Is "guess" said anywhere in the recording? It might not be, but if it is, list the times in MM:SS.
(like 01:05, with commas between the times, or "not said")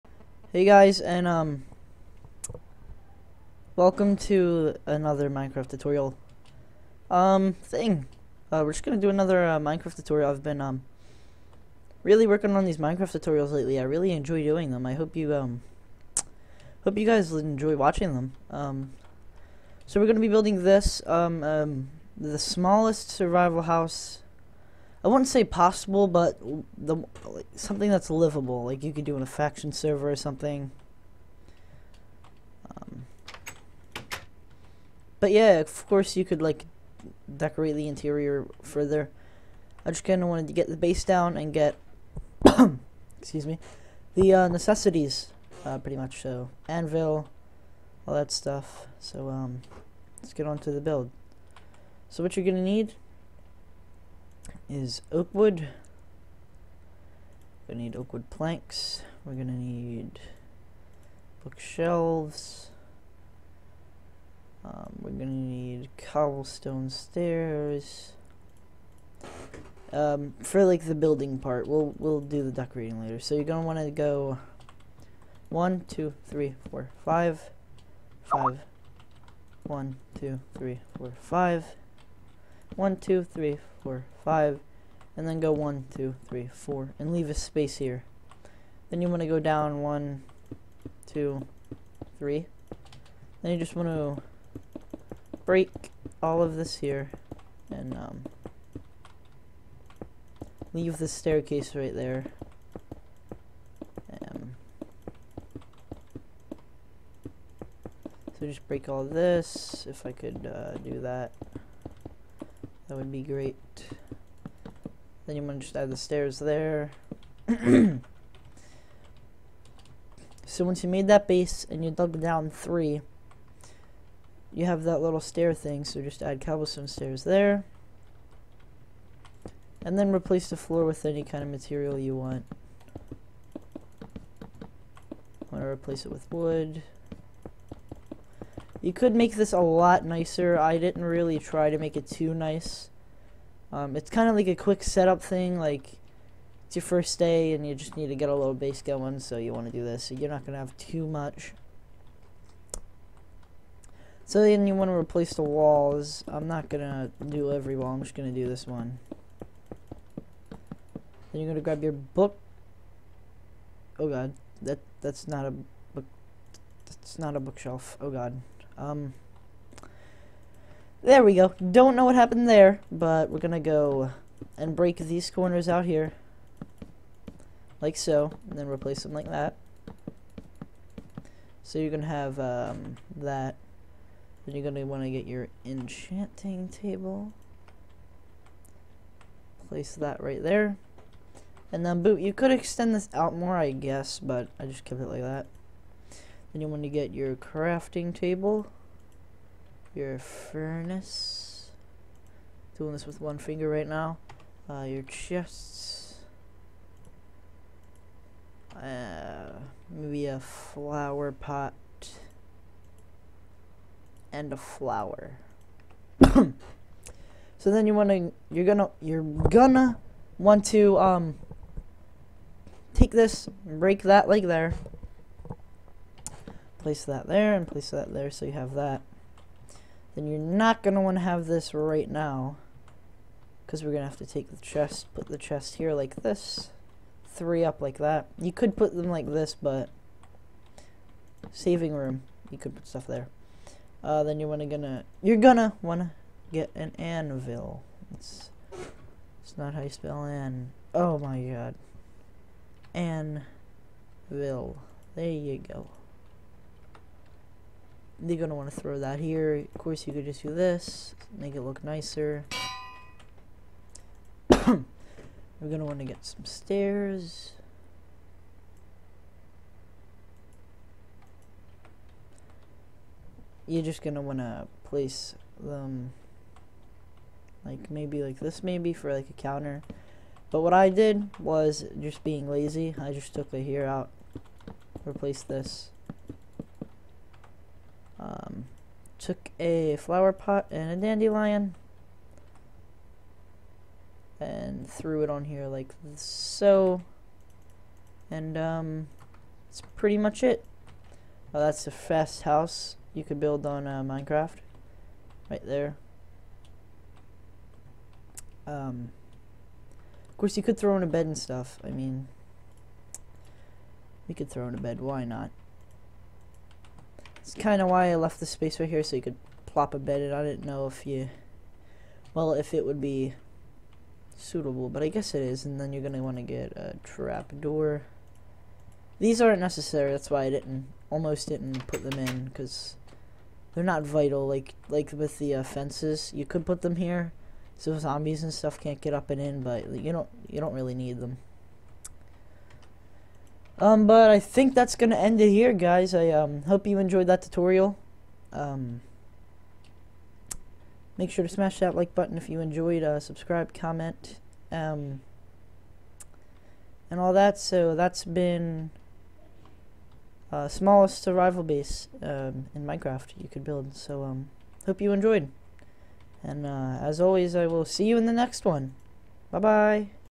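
03:13, 05:25.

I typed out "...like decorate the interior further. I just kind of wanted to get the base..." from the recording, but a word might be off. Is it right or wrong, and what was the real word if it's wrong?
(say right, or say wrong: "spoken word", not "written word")
right.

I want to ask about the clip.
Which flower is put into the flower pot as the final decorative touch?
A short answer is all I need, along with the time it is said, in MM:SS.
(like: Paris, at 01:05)
Dandelion, at 04:50.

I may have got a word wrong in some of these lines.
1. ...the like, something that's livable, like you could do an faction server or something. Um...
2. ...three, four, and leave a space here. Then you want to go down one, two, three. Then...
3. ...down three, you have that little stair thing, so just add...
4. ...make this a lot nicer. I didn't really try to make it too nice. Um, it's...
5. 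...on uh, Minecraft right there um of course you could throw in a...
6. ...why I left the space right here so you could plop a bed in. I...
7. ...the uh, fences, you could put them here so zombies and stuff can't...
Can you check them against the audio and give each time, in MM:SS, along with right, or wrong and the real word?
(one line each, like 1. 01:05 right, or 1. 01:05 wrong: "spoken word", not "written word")
1. 00:26 right
2. 01:26 right
3. 02:02 right
4. 02:19 right
5. 05:03 right
6. 05:17 right
7. 05:35 right.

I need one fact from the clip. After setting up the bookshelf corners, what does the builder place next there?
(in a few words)
Enchanting table.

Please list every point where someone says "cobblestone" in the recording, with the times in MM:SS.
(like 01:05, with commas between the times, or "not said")
01:05, 02:06.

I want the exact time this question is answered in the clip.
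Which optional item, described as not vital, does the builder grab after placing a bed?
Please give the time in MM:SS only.
05:27.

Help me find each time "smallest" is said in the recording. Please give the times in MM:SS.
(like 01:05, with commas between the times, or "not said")
00:22, 06:00.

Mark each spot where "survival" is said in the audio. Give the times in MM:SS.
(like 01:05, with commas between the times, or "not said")
00:23, 06:01.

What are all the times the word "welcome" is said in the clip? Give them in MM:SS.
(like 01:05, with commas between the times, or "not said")
00:03.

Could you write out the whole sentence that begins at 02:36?
I'm not going to do every wall, I'm just going to do this one.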